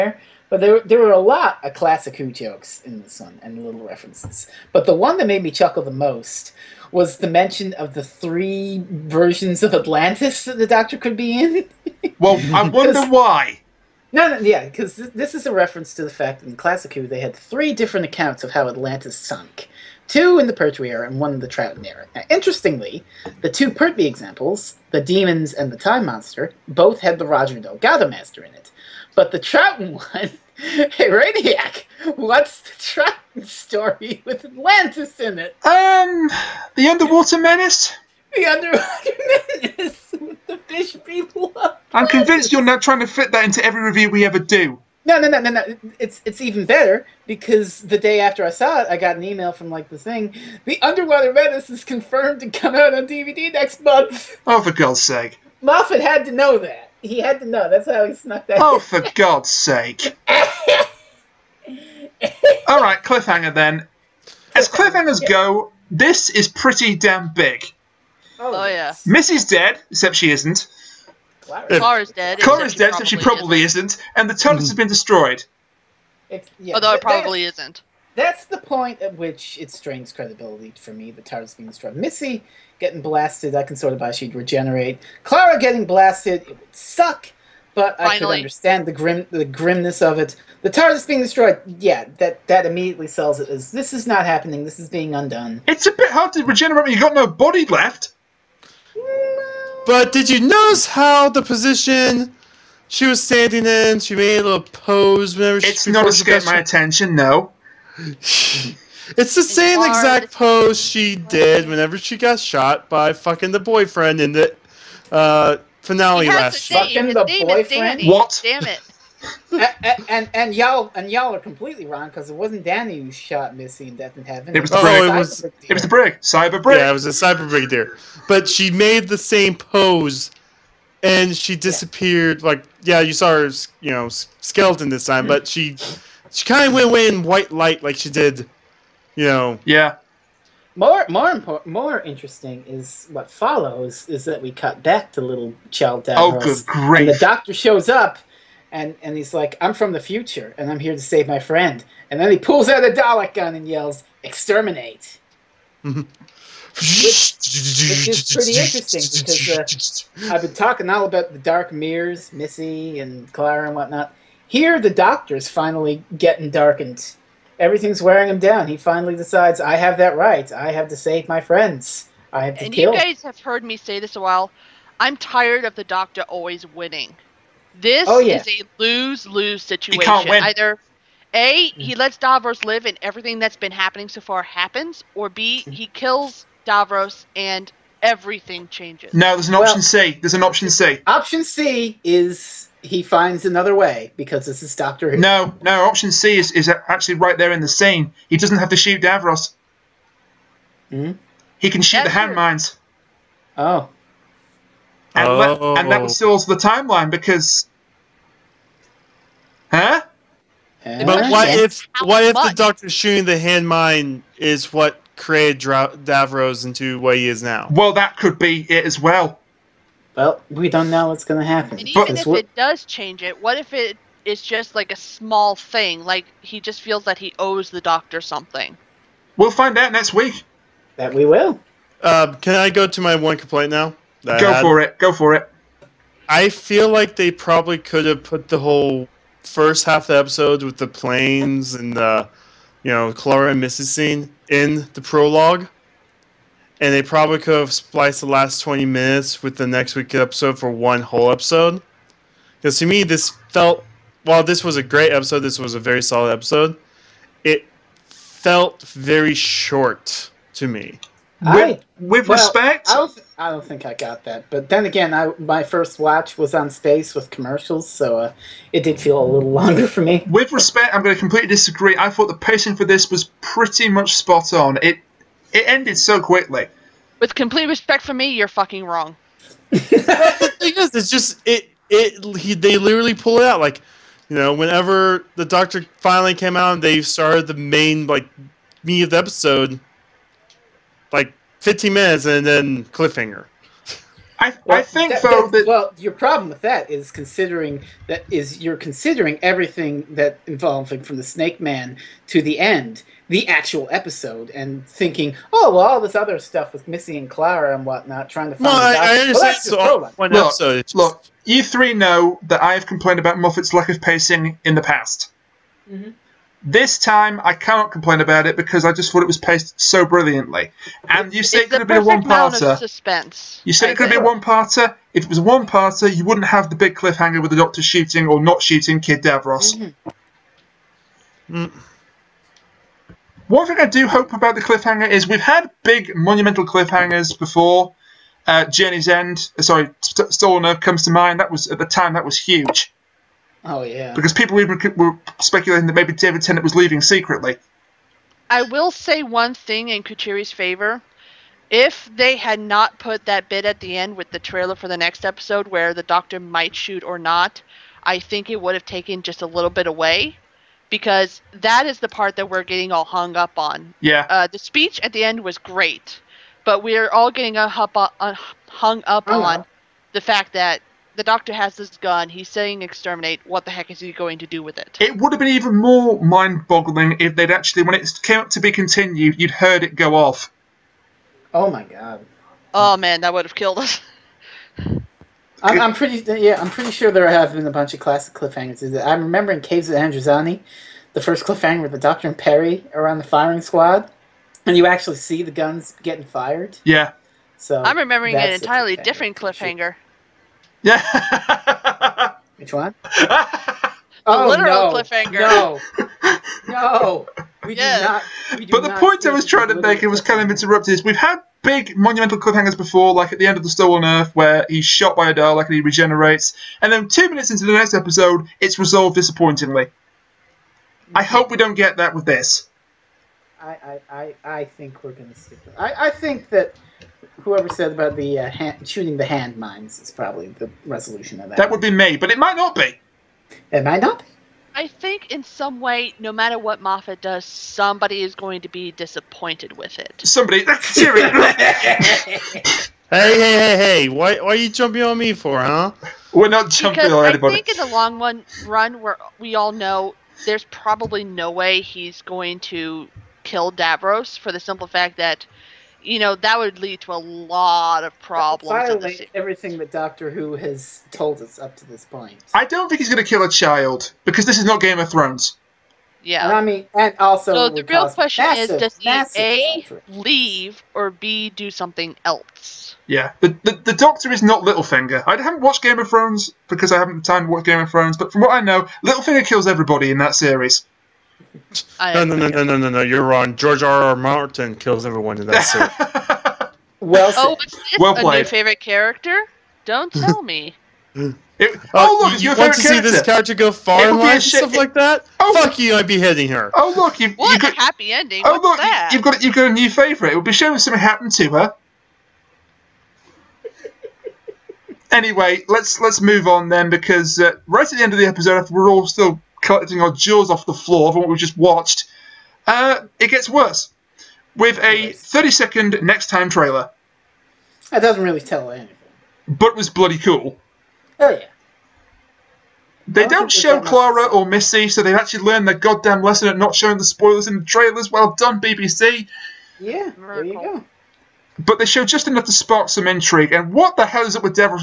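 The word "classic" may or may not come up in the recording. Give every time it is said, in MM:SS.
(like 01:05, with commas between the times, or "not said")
00:01, 00:16, 06:27.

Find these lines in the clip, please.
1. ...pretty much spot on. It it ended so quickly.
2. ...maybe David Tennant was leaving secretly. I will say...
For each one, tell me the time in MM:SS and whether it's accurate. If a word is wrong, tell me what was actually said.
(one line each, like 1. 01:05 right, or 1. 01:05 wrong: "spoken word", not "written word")
1. 04:33 right
2. 05:45 right.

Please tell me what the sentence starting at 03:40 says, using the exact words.
Well, we don't know what's going to happen.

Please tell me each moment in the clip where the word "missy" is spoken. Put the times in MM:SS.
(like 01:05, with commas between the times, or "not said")
01:09, 01:21, 02:03, 02:42, 05:06, 08:44.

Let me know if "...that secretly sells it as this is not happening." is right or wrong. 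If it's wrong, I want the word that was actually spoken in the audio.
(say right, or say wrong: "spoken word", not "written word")
wrong: "immediately", not "secretly".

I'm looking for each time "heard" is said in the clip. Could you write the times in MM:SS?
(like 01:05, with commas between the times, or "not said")
02:53, 06:19.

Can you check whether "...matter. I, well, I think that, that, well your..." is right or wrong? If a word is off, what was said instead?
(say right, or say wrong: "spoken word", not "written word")
wrong: "cliffhanger", not "matter".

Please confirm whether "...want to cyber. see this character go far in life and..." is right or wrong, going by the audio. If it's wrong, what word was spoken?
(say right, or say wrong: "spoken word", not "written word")
wrong: "character", not "cyber".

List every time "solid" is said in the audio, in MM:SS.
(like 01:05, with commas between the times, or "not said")
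04:16.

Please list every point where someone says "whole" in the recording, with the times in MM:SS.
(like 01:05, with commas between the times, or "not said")
03:58, 04:11.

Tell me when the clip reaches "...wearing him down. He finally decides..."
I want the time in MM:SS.
02:48.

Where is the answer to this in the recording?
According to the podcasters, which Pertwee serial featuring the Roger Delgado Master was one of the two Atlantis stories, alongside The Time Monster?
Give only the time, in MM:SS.
00:24.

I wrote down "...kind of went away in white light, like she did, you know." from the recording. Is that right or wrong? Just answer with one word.
right.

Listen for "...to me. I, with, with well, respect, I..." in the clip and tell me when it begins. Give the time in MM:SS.
04:20.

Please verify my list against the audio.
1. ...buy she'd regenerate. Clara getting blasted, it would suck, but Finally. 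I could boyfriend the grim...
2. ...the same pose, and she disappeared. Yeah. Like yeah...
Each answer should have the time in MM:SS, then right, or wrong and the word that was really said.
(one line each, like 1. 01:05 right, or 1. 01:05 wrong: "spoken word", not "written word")
1. 01:23 wrong: "understand", not "boyfriend"
2. 02:09 right.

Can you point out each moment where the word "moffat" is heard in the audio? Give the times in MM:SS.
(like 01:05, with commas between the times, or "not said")
00:55, 05:13, 07:16.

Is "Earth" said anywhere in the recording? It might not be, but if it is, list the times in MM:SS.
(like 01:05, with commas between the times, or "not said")
05:40, 06:54.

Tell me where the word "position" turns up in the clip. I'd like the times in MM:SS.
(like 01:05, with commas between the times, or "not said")
01:41.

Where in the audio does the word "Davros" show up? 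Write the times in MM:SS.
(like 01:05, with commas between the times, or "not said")
02:26, 03:02, 03:06, 03:19, 03:35, 05:29, 07:33.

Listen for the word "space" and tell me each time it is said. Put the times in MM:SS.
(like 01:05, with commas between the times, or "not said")
04:26.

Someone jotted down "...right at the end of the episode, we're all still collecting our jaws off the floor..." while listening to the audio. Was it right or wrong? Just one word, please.
right.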